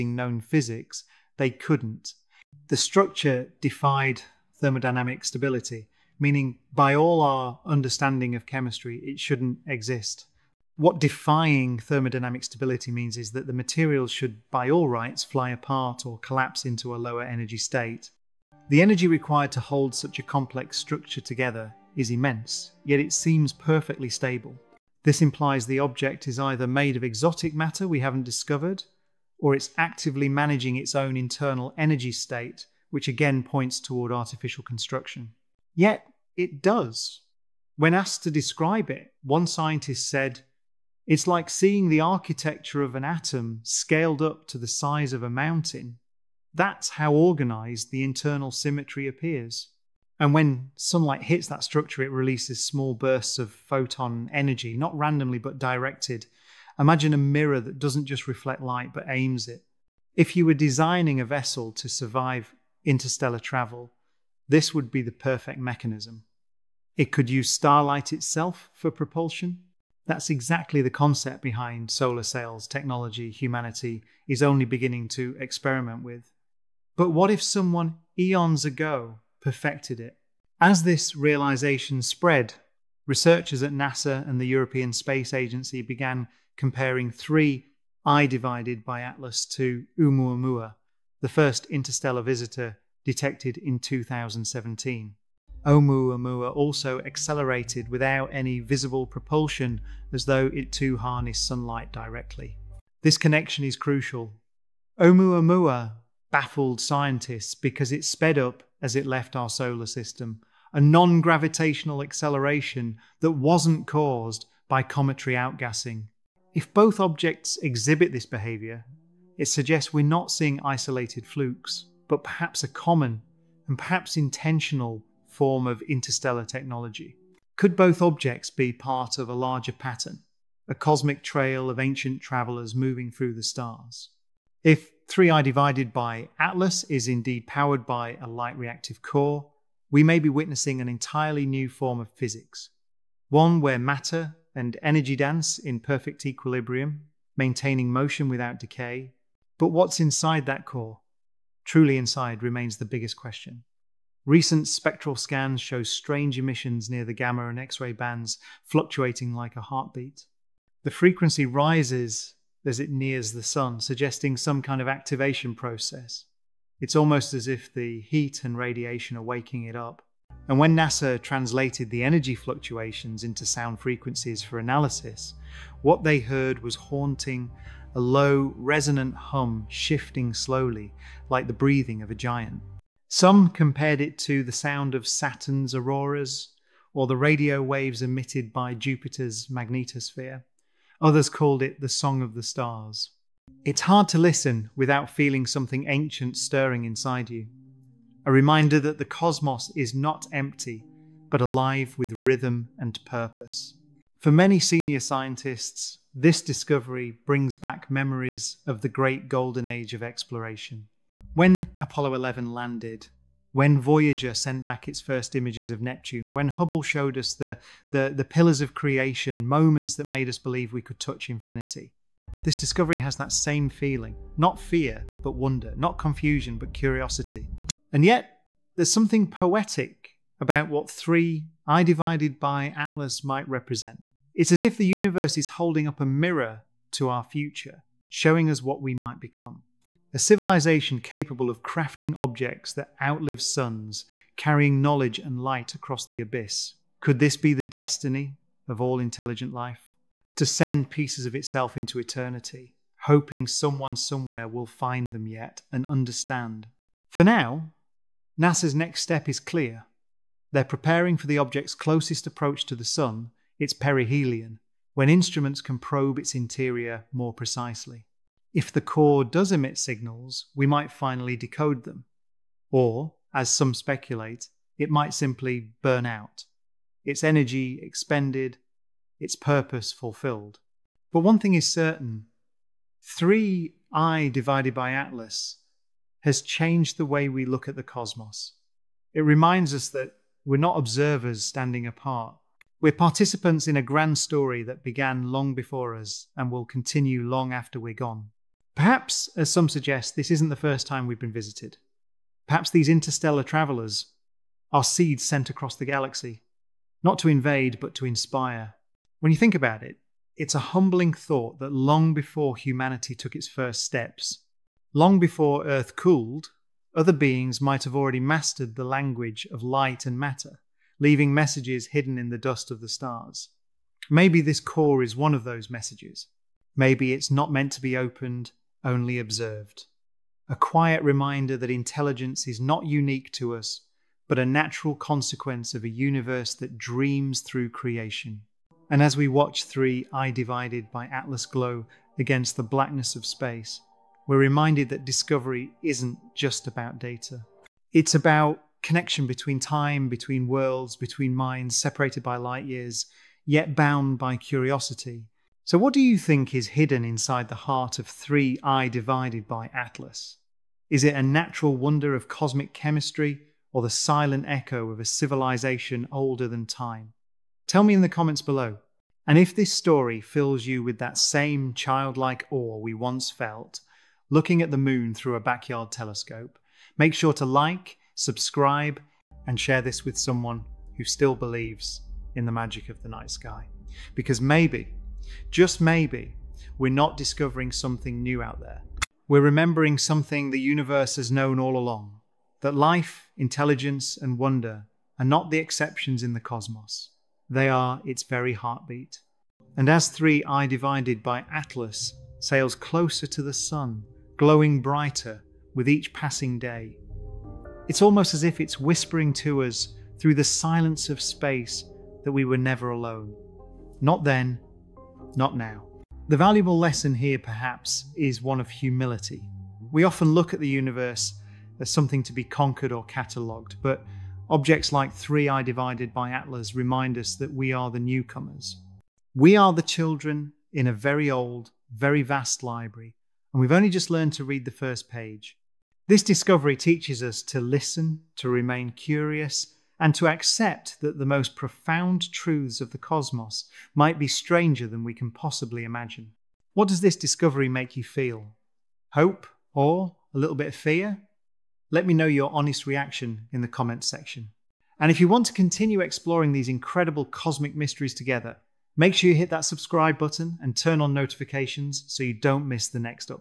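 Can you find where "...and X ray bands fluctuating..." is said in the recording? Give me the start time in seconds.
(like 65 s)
157 s.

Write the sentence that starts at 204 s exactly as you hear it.
For many senior scientists, this discovery brings back memories of the great golden age of exploration.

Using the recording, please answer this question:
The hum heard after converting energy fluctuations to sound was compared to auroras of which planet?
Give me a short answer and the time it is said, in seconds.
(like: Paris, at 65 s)
Saturn, at 185 s.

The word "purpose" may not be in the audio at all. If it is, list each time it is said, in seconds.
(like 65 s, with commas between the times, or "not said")
203 s, 279 s.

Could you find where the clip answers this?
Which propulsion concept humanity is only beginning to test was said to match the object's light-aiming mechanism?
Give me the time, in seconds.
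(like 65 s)
71 s.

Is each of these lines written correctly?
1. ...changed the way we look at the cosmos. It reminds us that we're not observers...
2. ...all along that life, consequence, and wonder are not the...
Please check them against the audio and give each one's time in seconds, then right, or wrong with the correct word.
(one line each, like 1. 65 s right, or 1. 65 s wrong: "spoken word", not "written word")
1. 286 s right
2. 391 s wrong: "intelligence", not "consequence".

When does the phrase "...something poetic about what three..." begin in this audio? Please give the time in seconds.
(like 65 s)
228 s.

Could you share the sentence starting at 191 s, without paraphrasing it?
Others called it the Song of the Stars.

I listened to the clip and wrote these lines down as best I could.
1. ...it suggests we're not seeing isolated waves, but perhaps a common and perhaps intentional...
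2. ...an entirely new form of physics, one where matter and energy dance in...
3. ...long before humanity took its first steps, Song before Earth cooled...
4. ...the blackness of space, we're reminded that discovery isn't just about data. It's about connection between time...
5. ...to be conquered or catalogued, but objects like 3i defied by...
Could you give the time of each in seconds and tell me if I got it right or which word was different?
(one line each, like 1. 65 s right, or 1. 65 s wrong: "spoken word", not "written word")
1. 119 s wrong: "flukes", not "waves"
2. 140 s right
3. 311 s wrong: "Long", not "Song"
4. 342 s right
5. 422 s wrong: "divided", not "defied".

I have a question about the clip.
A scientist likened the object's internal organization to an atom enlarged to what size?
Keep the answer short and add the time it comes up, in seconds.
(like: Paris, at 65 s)
A mountain, at 45 s.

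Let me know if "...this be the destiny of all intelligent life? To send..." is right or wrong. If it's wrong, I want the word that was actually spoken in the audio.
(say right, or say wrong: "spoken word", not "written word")
right.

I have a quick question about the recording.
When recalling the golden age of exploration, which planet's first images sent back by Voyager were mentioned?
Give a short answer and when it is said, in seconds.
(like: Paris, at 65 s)
Neptune, at 215 s.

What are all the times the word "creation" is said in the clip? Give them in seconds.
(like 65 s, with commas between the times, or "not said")
218 s, 337 s.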